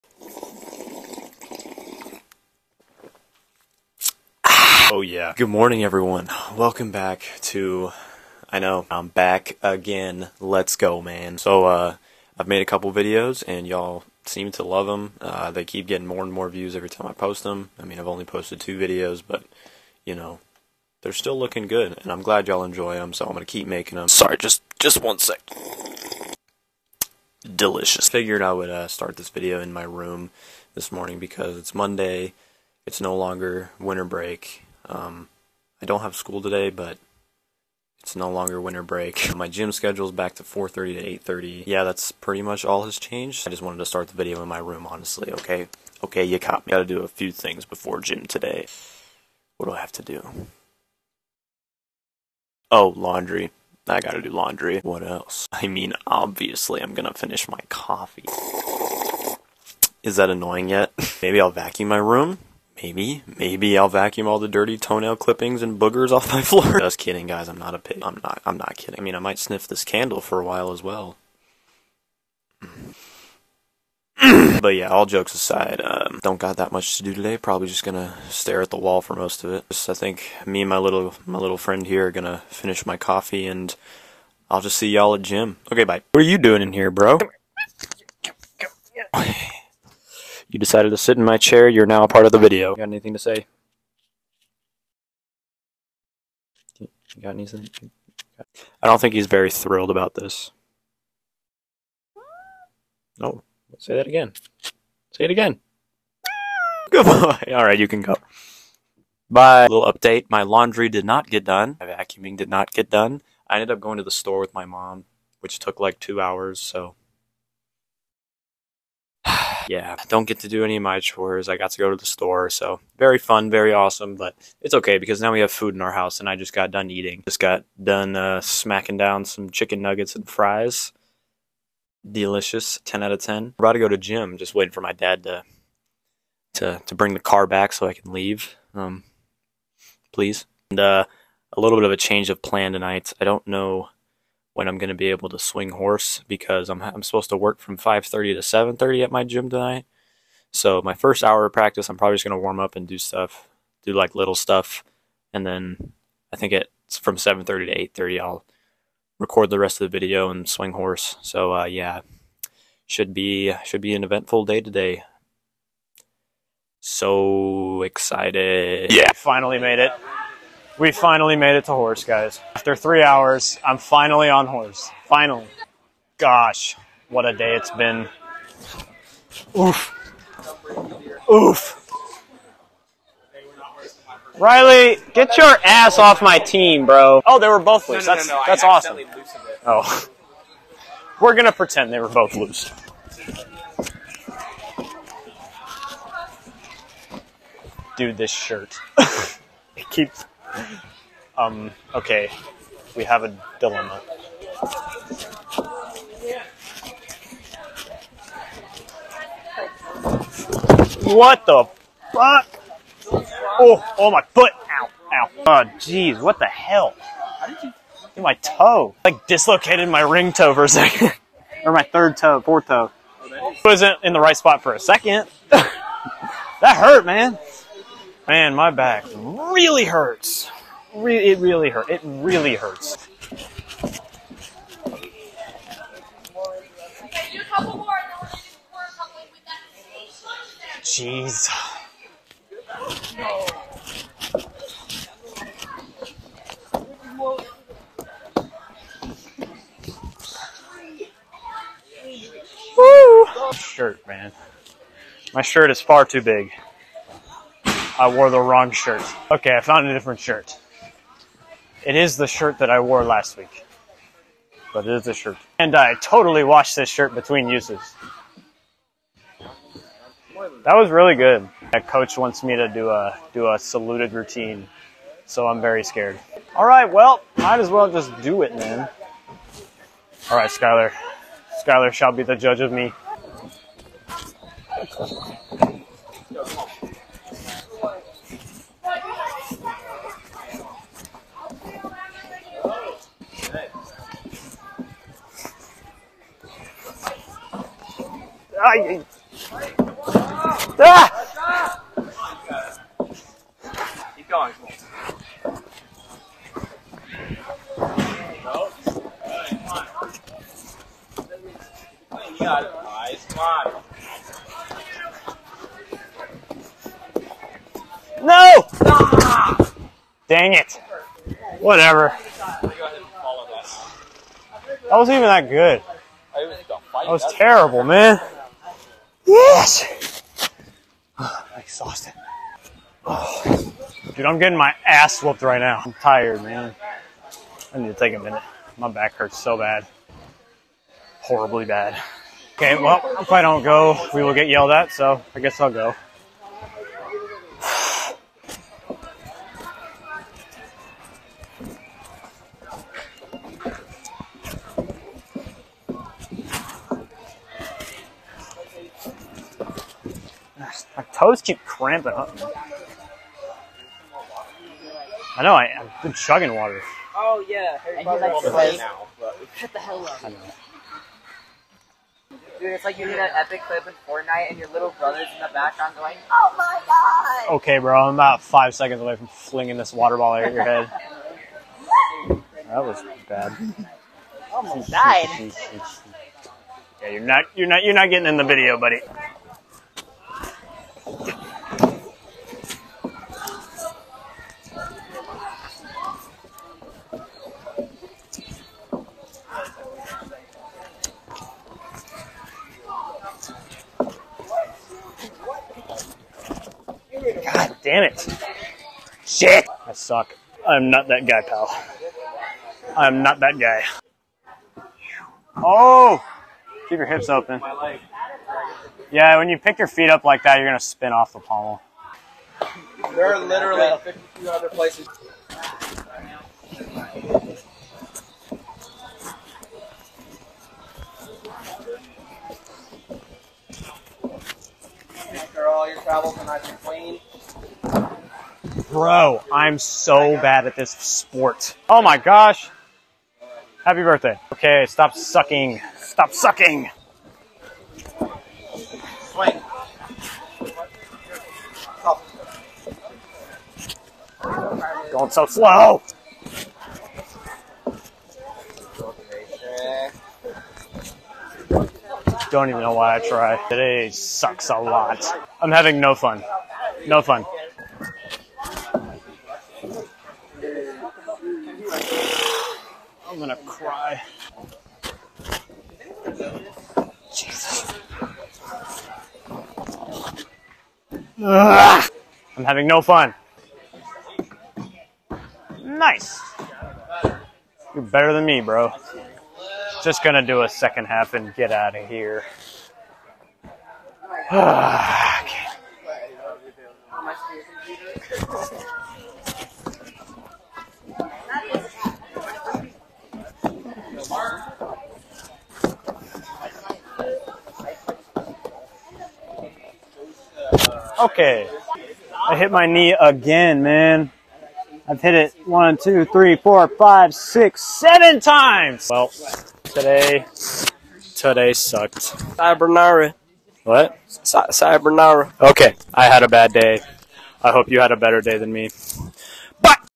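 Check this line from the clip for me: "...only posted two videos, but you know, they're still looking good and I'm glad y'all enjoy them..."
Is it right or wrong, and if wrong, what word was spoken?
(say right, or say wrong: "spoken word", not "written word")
right.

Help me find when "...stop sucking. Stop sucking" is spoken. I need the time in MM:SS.
07:24.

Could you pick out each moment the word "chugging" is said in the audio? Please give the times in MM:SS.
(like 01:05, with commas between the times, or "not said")
06:06.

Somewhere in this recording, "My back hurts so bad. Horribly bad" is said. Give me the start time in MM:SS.
05:38.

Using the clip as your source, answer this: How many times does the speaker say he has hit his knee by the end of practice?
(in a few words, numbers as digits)
7.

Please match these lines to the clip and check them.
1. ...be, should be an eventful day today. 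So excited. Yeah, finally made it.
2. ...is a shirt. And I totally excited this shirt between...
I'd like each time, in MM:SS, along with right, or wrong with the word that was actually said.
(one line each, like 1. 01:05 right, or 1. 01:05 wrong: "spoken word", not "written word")
1. 02:43 right
2. 04:24 wrong: "washed", not "excited".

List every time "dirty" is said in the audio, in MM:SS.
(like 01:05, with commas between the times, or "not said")
01:04.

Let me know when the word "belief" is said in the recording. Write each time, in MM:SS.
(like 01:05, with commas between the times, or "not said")
not said.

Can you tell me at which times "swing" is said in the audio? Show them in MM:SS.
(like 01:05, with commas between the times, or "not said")
02:25, 02:40, 07:29.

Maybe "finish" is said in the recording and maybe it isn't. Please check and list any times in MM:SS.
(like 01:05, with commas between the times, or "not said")
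00:57, 01:22.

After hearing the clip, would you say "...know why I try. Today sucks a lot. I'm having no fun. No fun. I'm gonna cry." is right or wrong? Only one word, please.
right.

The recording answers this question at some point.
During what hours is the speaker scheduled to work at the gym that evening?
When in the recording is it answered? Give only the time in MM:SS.
02:27.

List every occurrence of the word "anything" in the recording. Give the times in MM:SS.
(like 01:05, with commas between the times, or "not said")
01:32, 01:37.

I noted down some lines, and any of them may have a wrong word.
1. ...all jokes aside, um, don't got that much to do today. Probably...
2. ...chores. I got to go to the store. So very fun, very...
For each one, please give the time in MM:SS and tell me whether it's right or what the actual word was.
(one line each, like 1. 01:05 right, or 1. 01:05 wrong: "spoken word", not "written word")
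1. 01:14 right
2. 02:00 right.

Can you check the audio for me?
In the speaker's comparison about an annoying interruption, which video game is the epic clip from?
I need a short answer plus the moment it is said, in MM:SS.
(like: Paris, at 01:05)
Fortnite, at 06:14.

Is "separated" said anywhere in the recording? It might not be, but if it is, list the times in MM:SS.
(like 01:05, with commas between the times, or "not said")
not said.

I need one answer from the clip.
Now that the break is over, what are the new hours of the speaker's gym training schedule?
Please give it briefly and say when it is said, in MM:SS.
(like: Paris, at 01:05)
4:30 to 8:30, at 00:40.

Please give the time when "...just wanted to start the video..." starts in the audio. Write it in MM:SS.
00:43.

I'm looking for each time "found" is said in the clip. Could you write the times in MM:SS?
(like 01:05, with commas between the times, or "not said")
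04:19.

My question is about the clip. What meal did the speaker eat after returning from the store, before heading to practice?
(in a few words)
Chicken nuggets and fries.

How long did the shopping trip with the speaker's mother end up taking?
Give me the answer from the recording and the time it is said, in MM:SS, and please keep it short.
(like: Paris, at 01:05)
Two hours, at 01:56.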